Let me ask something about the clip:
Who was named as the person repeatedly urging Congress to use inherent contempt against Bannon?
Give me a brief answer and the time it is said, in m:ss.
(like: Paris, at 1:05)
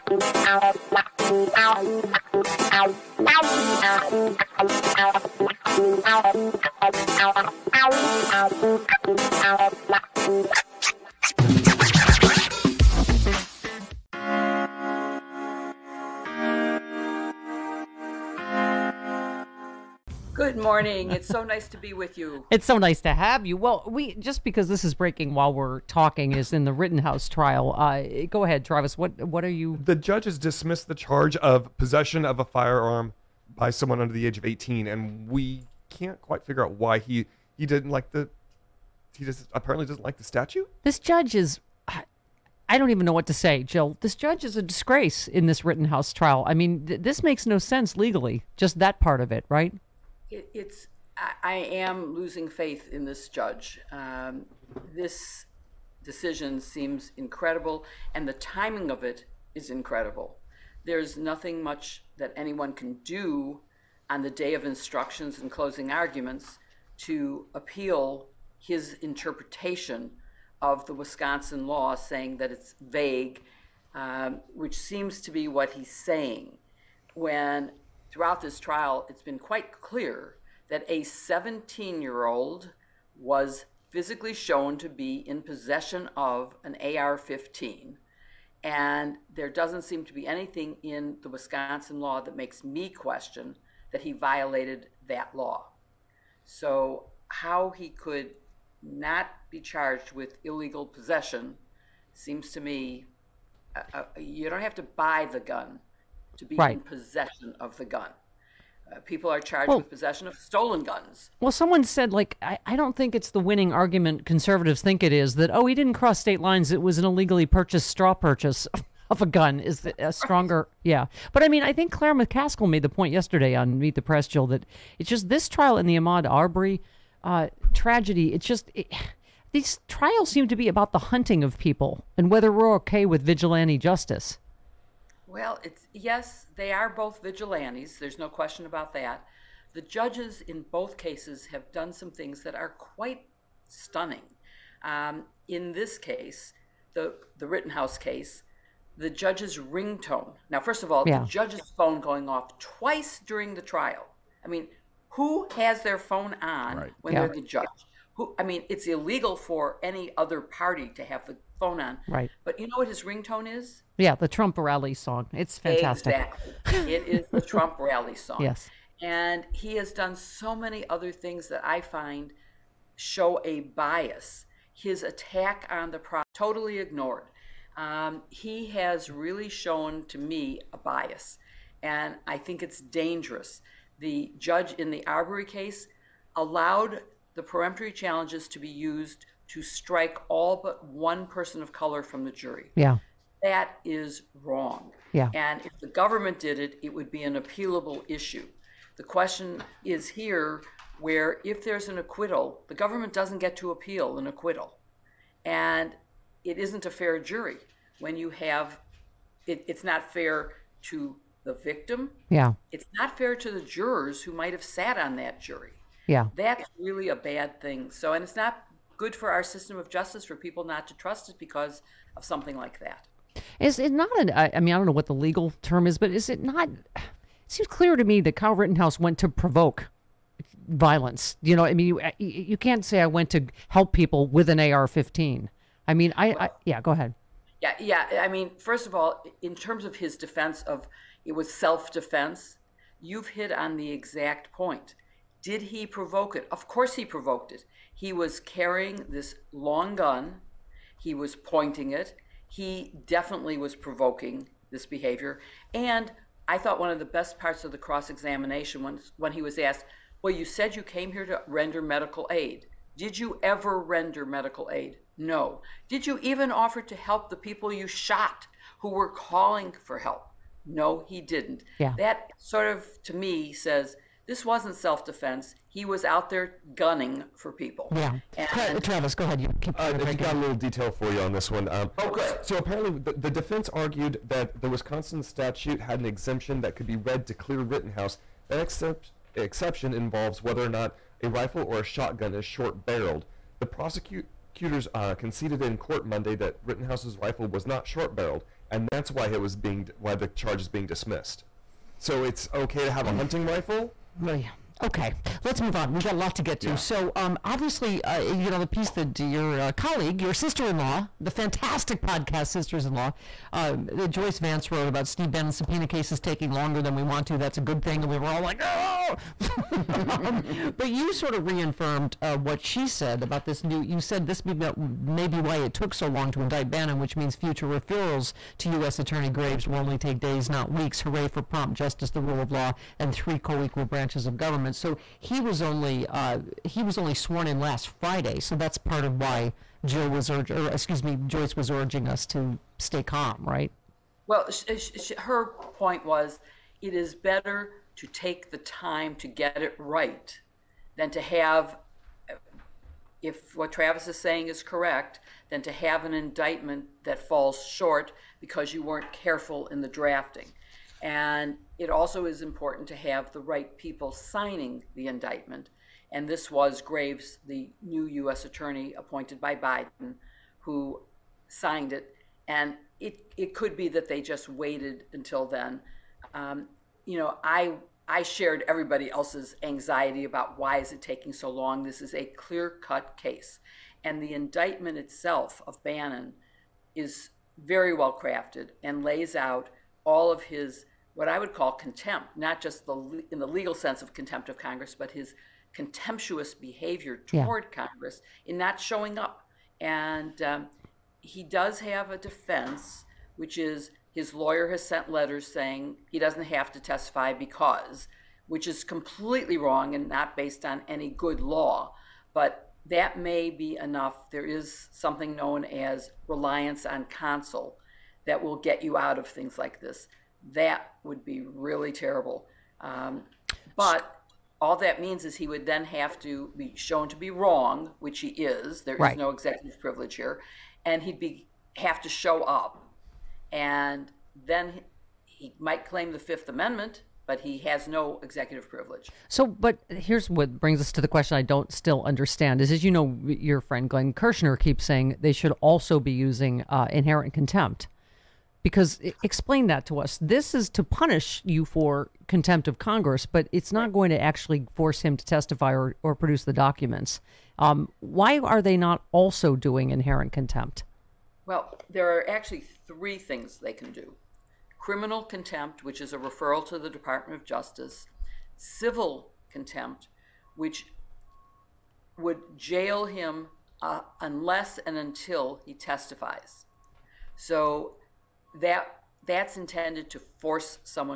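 Glenn Kirshner, at 7:23.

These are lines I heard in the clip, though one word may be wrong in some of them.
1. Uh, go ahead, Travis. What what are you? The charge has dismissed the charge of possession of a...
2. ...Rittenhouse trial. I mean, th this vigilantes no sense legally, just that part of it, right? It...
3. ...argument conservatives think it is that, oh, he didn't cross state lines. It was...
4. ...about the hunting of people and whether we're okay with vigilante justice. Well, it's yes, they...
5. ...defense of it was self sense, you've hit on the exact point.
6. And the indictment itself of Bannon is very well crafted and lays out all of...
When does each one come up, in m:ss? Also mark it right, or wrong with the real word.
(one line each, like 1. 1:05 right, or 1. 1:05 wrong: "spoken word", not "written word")
1. 0:27 wrong: "judge", not "charge"
2. 0:45 wrong: "makes", not "vigilantes"
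3. 1:53 right
4. 2:10 right
5. 4:00 wrong: "defense", not "sense"
6. 6:24 right.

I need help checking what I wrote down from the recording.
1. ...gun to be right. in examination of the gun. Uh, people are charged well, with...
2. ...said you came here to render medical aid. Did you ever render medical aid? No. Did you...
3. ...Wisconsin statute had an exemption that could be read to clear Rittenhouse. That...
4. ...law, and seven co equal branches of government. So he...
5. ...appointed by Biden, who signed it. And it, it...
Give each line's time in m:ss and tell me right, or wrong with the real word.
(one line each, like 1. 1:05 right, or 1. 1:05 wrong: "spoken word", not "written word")
1. 1:45 wrong: "possession", not "examination"
2. 4:20 right
3. 4:44 right
4. 5:32 wrong: "three", not "seven"
5. 6:08 right.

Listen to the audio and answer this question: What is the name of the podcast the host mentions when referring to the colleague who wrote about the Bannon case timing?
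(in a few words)
Sisters in Law.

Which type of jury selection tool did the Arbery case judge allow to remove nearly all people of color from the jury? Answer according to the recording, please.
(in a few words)
Peremptory challenge.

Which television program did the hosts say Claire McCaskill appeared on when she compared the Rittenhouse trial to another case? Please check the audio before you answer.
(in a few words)
Meet the Press.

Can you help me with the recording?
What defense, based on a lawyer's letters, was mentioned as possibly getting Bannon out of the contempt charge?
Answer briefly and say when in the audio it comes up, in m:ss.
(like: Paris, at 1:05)
Reliance on counsel, at 6:56.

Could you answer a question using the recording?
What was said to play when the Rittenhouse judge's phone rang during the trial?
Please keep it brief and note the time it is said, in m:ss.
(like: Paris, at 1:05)
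The Trump rally song, at 2:44.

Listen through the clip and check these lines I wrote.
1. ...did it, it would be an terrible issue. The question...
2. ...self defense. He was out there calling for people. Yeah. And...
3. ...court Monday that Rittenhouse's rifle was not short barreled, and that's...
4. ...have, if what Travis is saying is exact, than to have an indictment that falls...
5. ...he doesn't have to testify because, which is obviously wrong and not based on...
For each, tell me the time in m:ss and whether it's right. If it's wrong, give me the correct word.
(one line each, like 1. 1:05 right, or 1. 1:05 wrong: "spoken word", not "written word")
1. 3:16 wrong: "appealable", not "terrible"
2. 4:34 wrong: "gunning", not "calling"
3. 4:55 right
4. 5:51 wrong: "correct", not "exact"
5. 6:46 wrong: "completely", not "obviously".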